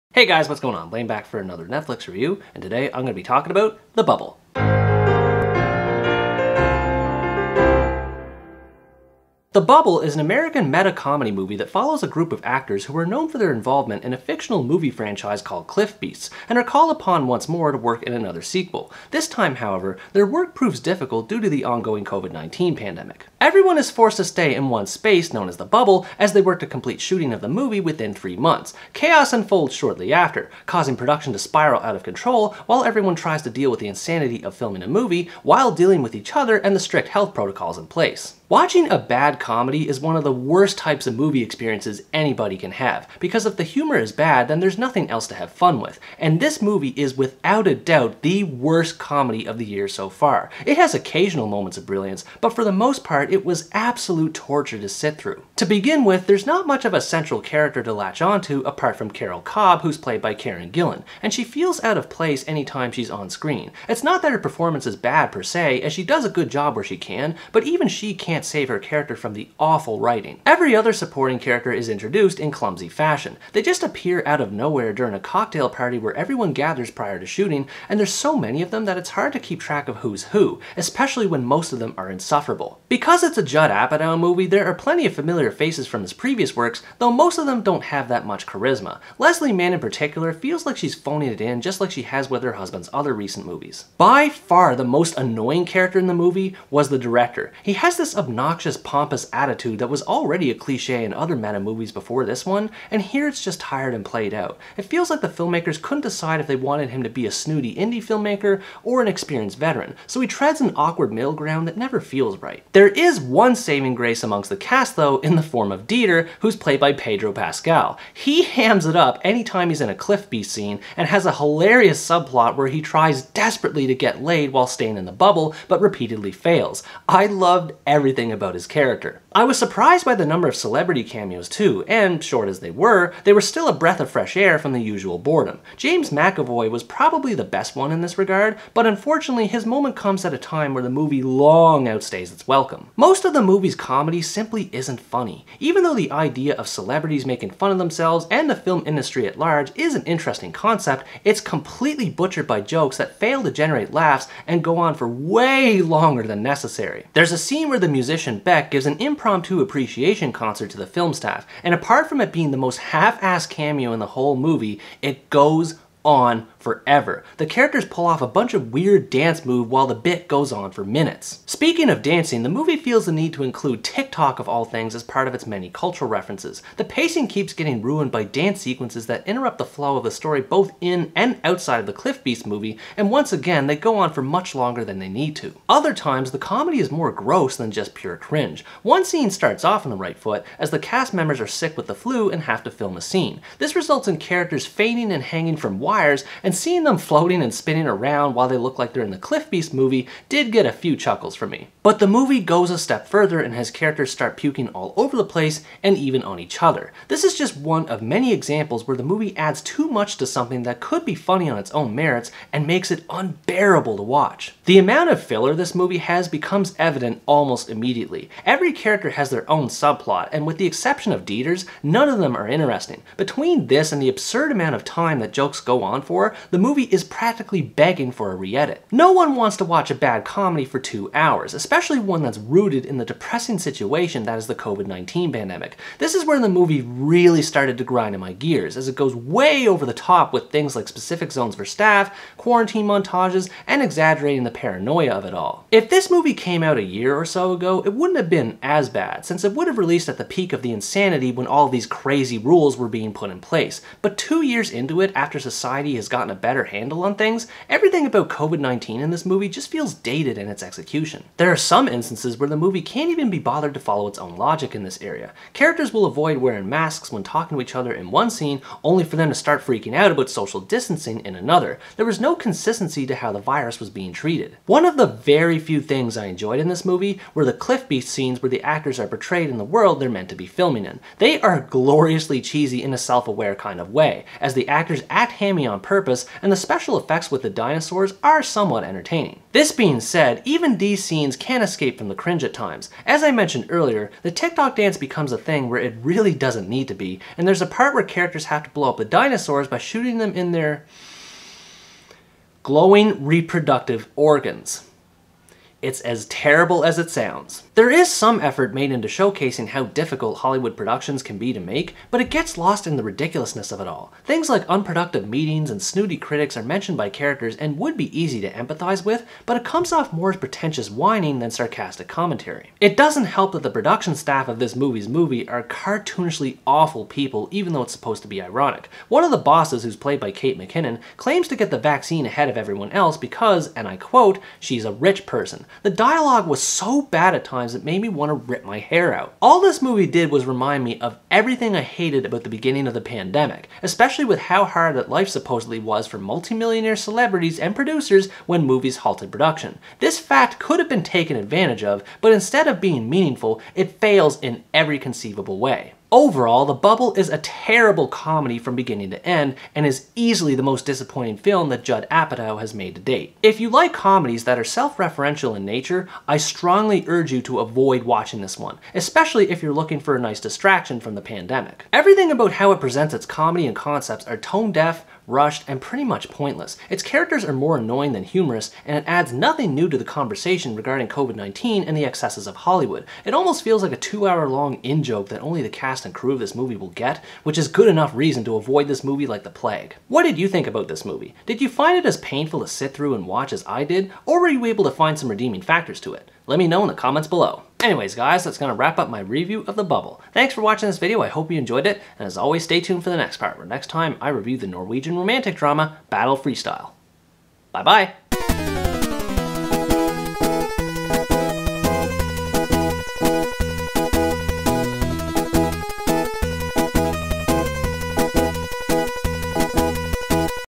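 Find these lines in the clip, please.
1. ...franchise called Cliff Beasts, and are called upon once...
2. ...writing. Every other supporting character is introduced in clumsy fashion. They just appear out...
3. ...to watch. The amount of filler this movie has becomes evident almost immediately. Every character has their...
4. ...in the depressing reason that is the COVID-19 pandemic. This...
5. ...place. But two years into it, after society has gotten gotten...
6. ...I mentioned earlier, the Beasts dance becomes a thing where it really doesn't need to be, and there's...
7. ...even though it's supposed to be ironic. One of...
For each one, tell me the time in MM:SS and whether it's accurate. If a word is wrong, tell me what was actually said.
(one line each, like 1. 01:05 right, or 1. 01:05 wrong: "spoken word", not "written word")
1. 00:14 right
2. 01:10 right
3. 03:33 right
4. 03:52 wrong: "situation", not "reason"
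5. 04:13 right
6. 04:53 wrong: "TikTok", not "Beasts"
7. 05:27 right.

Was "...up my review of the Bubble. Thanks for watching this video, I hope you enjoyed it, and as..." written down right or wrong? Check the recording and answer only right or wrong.
right.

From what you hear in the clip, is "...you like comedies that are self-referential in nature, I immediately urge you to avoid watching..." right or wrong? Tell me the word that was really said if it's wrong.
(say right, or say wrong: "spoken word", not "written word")
wrong: "strongly", not "immediately".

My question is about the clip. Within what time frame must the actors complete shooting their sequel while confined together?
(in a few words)
three months.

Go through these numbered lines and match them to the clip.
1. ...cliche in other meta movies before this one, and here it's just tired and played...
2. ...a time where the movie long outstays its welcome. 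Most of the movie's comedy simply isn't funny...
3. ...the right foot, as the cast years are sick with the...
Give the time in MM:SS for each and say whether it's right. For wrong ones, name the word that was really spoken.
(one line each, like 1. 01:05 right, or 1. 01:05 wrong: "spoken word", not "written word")
1. 01:40 right
2. 02:20 right
3. 03:09 wrong: "members", not "years".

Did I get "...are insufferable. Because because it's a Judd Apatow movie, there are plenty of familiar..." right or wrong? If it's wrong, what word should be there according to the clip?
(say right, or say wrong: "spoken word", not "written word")
right.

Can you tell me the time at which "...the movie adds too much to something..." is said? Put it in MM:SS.
03:28.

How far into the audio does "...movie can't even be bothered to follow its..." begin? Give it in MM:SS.
04:22.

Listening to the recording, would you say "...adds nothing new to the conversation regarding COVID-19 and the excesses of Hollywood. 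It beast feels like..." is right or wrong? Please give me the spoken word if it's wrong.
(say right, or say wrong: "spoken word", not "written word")
wrong: "almost", not "beast".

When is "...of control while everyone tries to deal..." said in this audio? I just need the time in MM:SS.
00:31.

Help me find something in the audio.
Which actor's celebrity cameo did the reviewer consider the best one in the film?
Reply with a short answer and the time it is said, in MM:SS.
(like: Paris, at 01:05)
James McAvoy, at 02:15.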